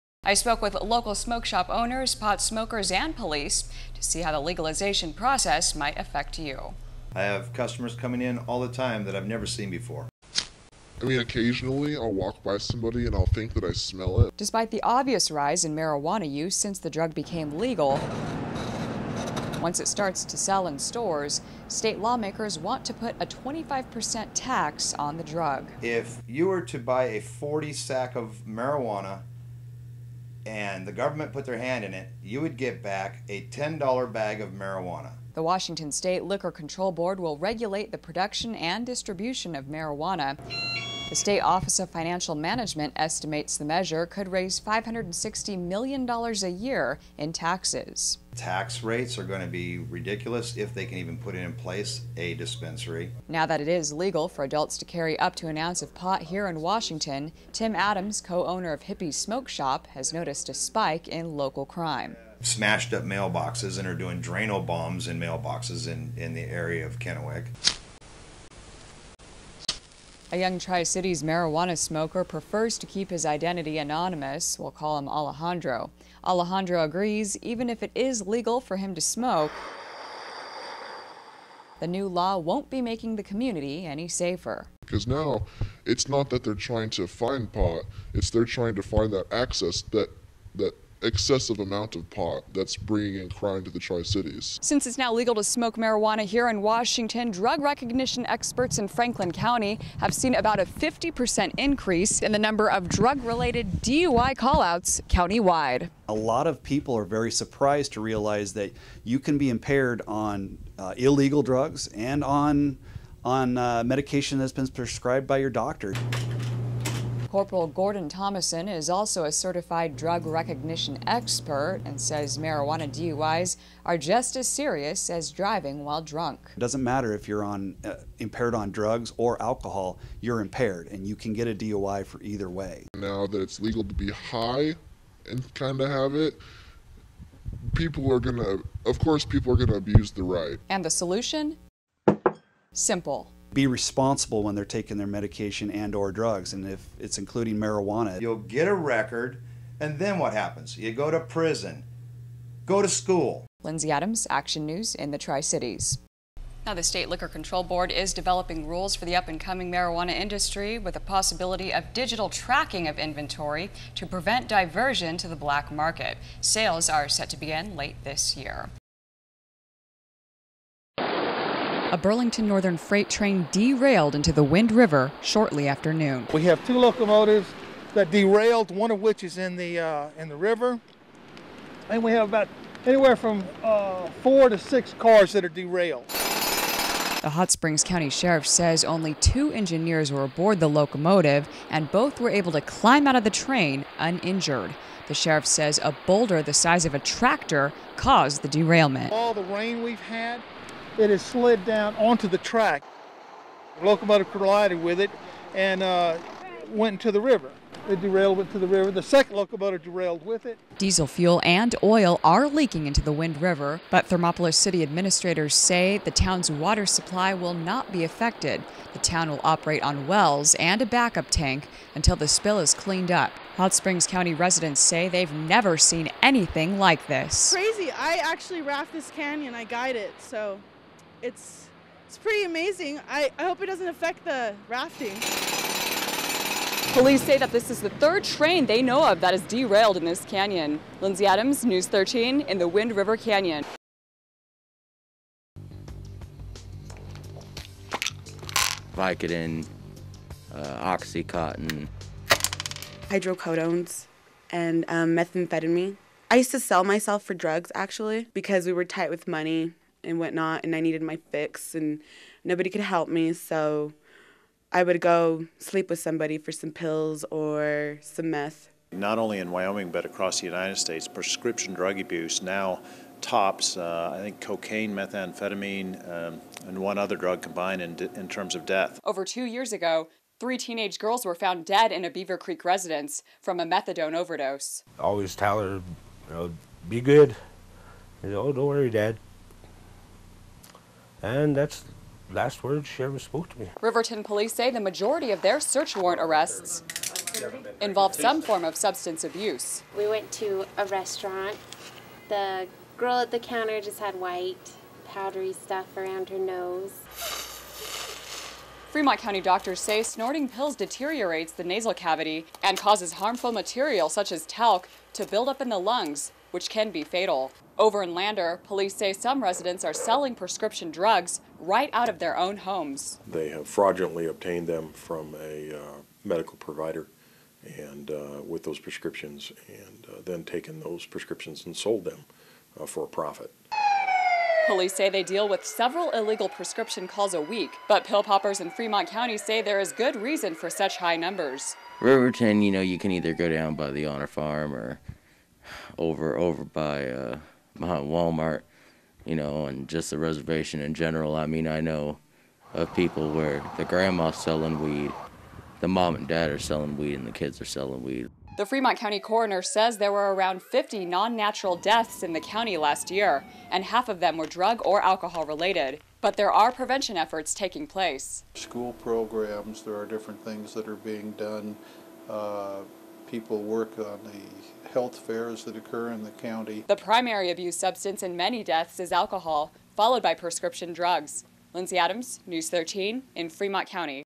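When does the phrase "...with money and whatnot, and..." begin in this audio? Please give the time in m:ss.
4:19.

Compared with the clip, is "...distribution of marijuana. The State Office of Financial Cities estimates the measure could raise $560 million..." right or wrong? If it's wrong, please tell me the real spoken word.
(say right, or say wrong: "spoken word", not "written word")
wrong: "Management", not "Cities".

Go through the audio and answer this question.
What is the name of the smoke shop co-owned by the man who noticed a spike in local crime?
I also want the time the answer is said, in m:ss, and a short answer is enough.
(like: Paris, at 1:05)
Hippie Smoke Shop, at 0:58.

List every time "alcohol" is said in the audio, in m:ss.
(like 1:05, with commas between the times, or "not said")
2:09, 6:05, 6:19.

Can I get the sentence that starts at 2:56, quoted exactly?
We have two locomotives that derailed, one of which is in the, uh, in the river.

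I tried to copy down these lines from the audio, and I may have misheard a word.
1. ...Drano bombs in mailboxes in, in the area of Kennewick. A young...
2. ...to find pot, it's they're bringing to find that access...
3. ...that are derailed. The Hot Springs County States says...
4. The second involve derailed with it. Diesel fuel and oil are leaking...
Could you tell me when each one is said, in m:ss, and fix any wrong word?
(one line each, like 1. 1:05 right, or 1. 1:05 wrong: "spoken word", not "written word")
1. 1:04 right
2. 1:26 wrong: "trying", not "bringing"
3. 3:05 wrong: "Sheriff", not "States"
4. 3:28 wrong: "locomotive", not "involve".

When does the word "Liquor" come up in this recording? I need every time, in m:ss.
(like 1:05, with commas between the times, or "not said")
0:36, 2:37.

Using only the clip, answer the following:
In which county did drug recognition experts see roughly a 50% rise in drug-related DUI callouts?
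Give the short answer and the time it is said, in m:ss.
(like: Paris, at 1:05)
Franklin County, at 1:38.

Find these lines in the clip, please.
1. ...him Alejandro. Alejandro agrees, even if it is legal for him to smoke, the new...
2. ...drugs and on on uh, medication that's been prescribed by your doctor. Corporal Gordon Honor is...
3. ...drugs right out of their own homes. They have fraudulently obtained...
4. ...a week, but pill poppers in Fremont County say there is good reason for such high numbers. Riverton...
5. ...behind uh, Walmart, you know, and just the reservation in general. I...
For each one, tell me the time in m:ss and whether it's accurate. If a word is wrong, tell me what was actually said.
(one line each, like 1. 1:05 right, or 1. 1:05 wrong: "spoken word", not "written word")
1. 1:14 right
2. 1:51 wrong: "Thomason", not "Honor"
3. 5:20 right
4. 5:37 right
5. 5:47 right.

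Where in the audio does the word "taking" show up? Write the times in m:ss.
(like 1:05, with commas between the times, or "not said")
2:24, 6:07.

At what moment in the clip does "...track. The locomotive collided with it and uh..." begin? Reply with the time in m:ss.
3:22.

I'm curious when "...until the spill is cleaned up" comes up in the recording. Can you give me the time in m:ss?
3:41.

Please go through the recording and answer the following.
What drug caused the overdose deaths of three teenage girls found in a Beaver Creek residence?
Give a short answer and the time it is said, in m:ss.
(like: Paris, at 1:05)
Methadone, at 4:43.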